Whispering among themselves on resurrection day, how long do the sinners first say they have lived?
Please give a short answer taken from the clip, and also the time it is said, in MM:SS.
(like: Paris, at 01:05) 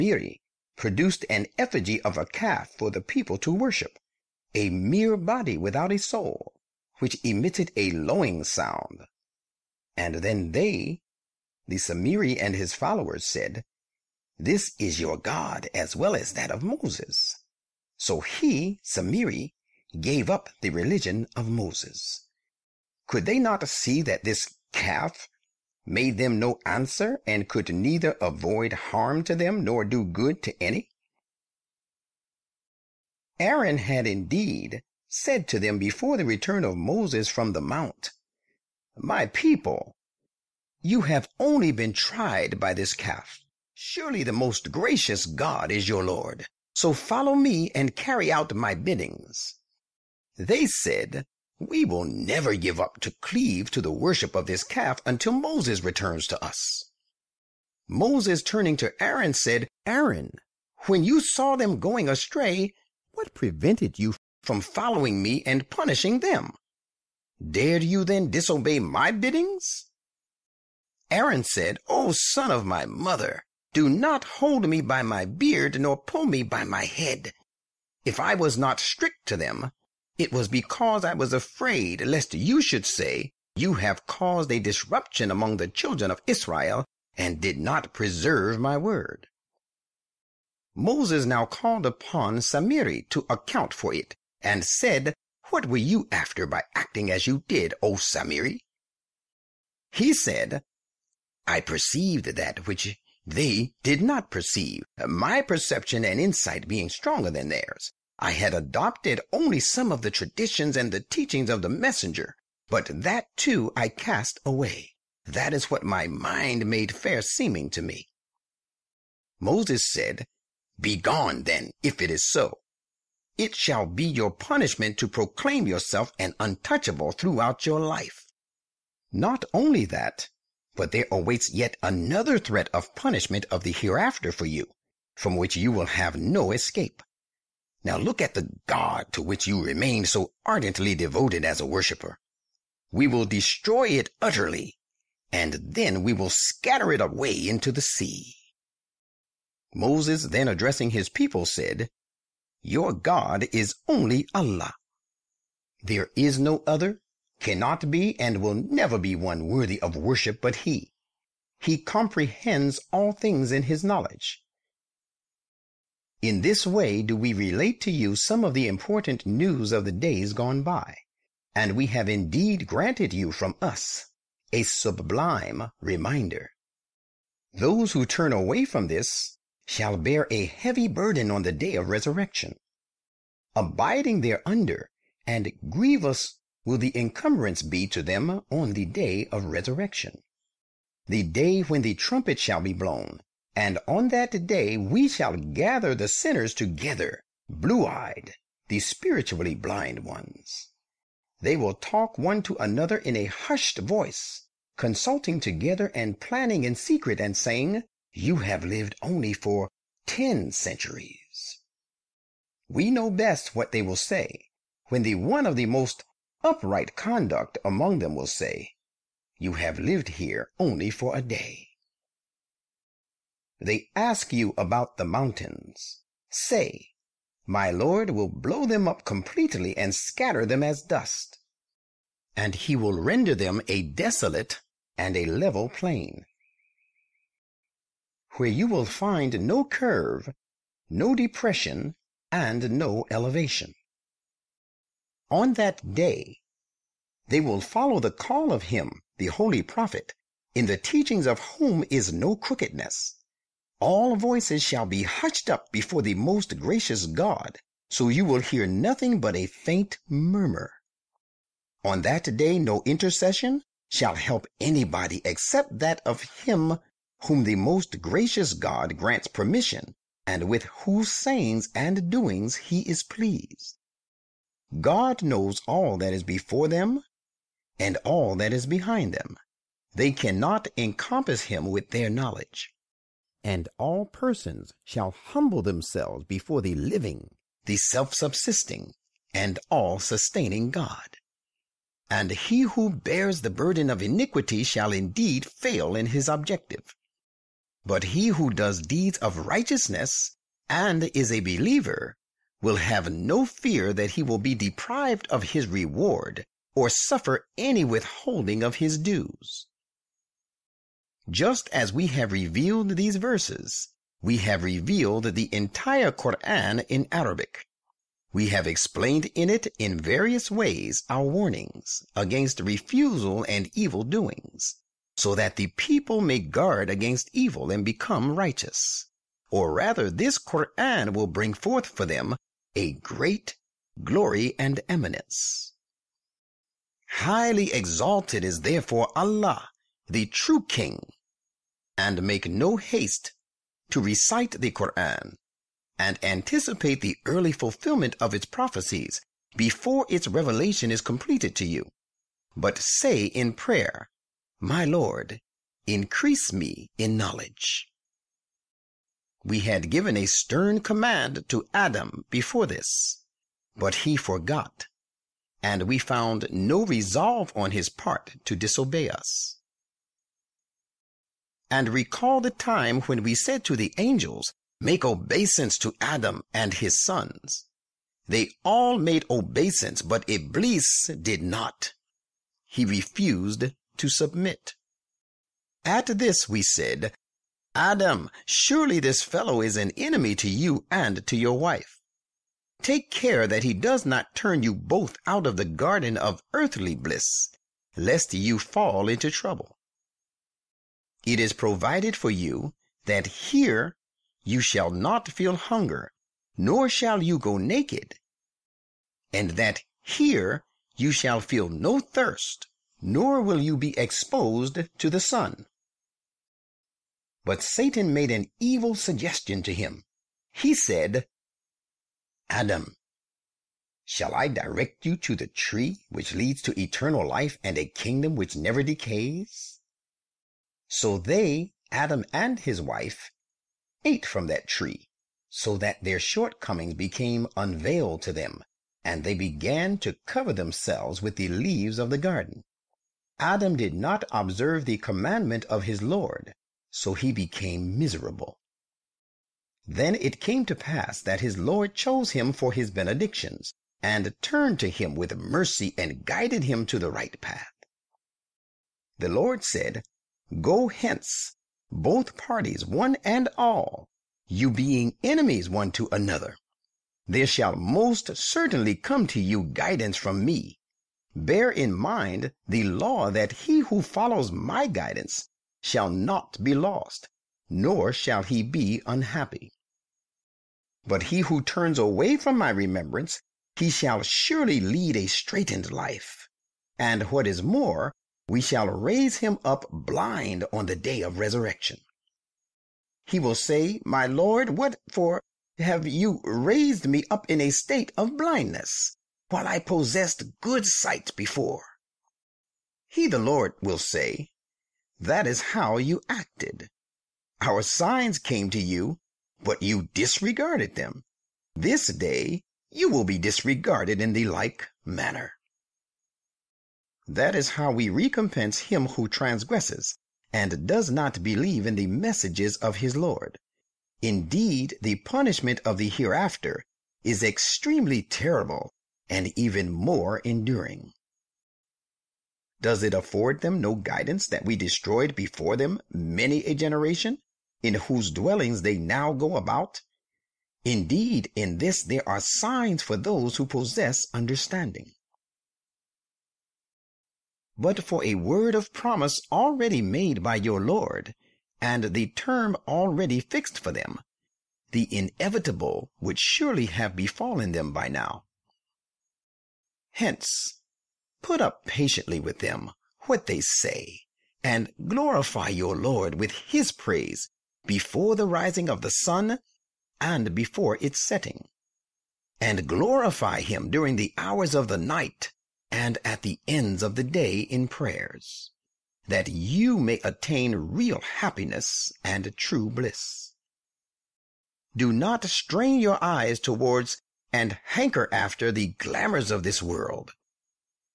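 Ten centuries, at 03:30.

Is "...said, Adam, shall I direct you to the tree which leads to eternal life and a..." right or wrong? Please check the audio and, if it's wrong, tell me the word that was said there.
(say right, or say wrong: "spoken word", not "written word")
right.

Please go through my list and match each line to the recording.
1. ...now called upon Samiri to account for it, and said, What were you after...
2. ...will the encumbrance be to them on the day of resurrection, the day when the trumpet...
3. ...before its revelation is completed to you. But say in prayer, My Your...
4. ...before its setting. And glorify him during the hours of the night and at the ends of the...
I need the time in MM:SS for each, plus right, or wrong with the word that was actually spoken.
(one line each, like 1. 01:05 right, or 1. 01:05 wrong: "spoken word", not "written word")
1. 01:31 right
2. 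03:06 right
3. 05:49 wrong: "Lord", not "Your"
4. 09:30 right.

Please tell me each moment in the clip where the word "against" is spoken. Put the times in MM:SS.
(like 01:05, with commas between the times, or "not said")
05:22, 05:26.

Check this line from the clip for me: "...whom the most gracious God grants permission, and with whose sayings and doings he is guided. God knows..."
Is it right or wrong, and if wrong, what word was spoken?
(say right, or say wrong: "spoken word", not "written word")
wrong: "pleased", not "guided".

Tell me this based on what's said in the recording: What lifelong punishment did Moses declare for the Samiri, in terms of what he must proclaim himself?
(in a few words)
An untouchable.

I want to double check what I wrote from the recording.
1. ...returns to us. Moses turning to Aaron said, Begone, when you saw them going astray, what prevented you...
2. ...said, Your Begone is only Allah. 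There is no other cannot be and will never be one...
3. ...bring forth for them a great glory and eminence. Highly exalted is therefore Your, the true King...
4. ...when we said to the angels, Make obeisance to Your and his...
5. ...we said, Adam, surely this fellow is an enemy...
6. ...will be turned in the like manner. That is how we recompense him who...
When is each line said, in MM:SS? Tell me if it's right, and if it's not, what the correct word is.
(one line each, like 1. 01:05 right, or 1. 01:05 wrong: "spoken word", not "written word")
1. 00:55 wrong: "Aaron", not "Begone"
2. 02:31 wrong: "God", not "Begone"
3. 05:31 wrong: "Allah", not "Your"
4. 06:13 wrong: "Adam", not "Your"
5. 06:26 right
6. 08:33 wrong: "disregarded", not "turned".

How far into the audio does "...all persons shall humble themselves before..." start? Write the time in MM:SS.
04:43.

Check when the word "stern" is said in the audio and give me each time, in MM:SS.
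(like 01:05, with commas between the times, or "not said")
06:00.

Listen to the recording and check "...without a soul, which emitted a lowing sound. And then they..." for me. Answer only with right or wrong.
right.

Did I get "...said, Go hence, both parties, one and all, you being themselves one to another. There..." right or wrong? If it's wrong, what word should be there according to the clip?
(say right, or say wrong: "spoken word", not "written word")
wrong: "enemies", not "themselves".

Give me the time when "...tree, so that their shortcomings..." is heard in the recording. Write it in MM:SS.
07:14.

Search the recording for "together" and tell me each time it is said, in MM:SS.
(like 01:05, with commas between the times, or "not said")
03:16, 03:25.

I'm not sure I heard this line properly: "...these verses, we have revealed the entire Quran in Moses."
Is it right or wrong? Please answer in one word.
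wrong.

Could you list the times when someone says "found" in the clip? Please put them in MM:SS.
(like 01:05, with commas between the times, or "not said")
06:05.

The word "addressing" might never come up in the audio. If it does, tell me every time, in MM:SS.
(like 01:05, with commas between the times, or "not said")
02:30.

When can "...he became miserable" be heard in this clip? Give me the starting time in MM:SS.
07:27.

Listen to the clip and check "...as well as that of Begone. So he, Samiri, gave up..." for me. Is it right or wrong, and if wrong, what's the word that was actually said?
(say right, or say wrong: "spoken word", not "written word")
wrong: "Moses", not "Begone".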